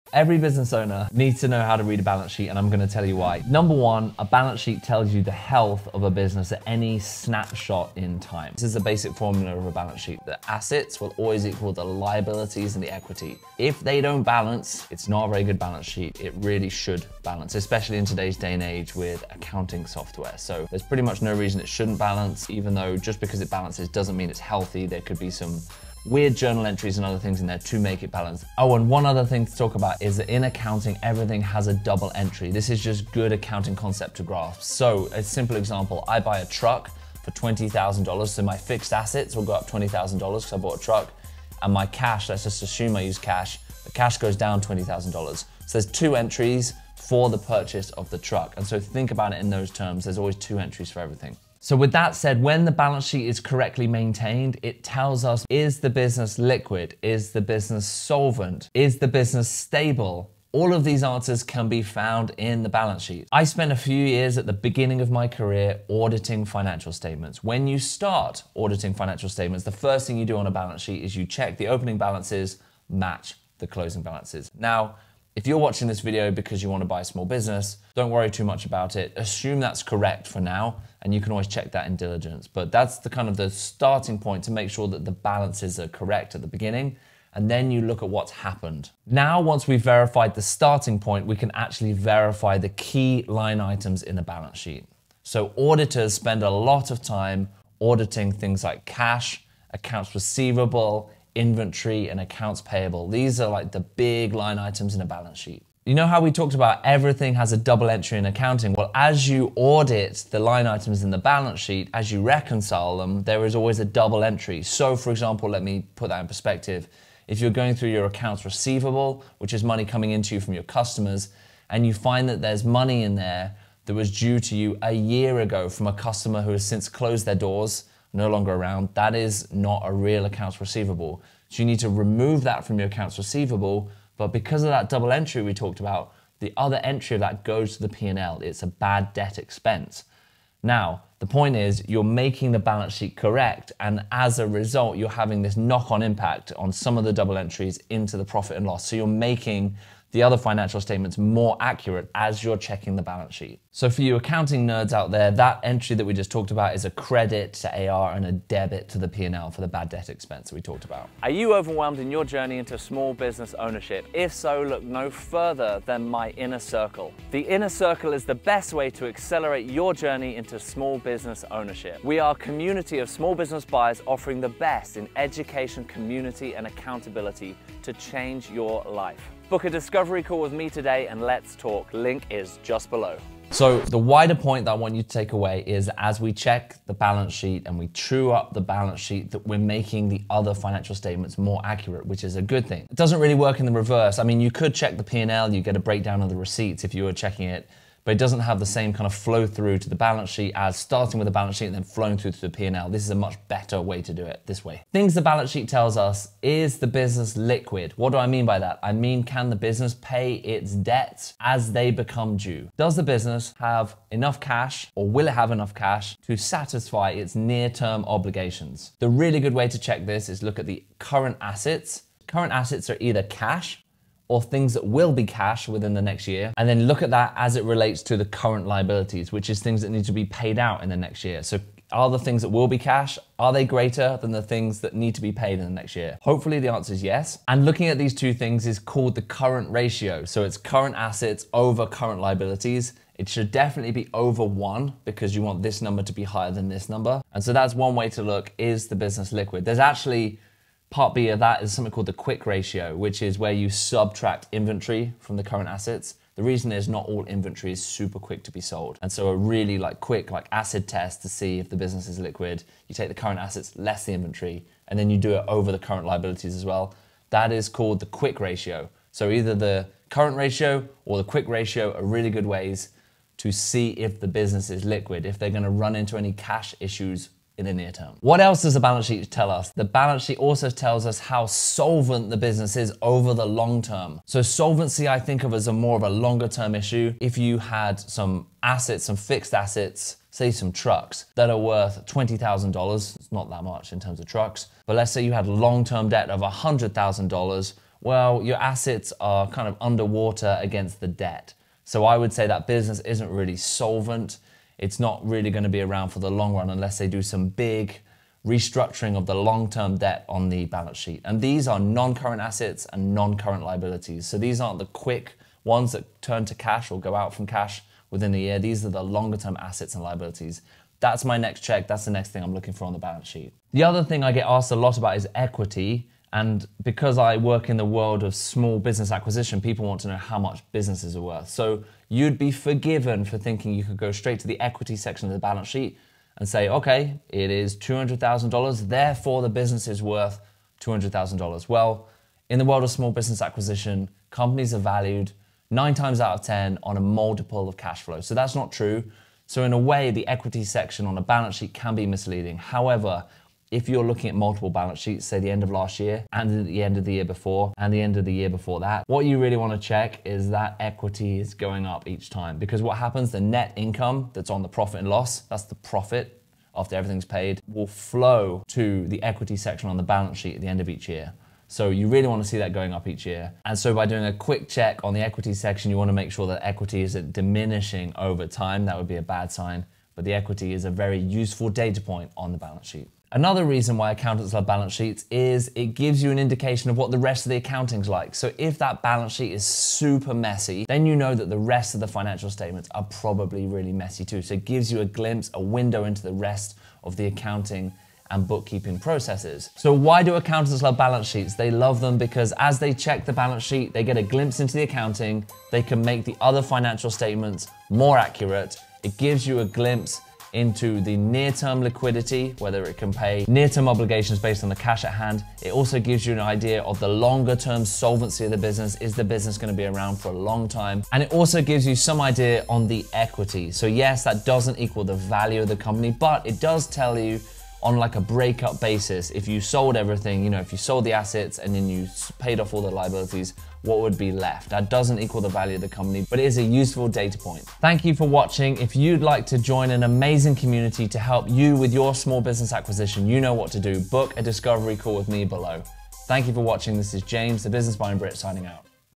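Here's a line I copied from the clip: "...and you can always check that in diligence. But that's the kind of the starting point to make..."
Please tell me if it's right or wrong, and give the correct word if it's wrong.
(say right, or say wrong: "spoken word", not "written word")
right.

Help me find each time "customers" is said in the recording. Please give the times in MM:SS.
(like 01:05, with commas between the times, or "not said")
02:00, 02:05.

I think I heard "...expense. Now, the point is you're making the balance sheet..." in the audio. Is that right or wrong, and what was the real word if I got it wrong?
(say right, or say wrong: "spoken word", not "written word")
right.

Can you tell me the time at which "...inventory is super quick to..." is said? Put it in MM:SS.
04:17.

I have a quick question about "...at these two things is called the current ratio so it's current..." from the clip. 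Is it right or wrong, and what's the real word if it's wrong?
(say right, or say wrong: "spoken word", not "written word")
right.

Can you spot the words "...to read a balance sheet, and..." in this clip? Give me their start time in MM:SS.
00:01.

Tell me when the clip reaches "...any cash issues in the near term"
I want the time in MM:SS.
04:36.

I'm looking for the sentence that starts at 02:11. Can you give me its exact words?
So you need to remove that from your accounts receivable.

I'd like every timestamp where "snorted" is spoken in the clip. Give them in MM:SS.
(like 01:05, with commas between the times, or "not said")
not said.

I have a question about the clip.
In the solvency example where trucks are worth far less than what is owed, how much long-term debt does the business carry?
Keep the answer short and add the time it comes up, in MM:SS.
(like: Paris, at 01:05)
$100,000, at 04:56.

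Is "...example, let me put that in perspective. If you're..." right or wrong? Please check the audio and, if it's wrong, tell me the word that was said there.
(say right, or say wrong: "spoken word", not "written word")
right.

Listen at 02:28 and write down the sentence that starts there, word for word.
So you're making the other financial statements more accurate as you're checking the balance sheet.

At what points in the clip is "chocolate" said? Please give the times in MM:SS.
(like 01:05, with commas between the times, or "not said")
not said.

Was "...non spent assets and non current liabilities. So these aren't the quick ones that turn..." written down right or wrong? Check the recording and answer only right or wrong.
wrong.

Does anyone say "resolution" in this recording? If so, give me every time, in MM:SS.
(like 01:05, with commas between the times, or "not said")
not said.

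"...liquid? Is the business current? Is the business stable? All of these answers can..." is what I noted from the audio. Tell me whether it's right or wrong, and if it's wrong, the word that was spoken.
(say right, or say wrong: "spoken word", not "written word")
wrong: "solvent", not "current".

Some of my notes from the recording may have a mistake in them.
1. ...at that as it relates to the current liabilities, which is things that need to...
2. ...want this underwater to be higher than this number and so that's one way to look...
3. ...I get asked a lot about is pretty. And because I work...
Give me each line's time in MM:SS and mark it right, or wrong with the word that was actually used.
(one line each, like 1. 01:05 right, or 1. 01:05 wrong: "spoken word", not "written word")
1. 03:47 right
2. 04:05 wrong: "number", not "underwater"
3. 05:24 wrong: "equity", not "pretty".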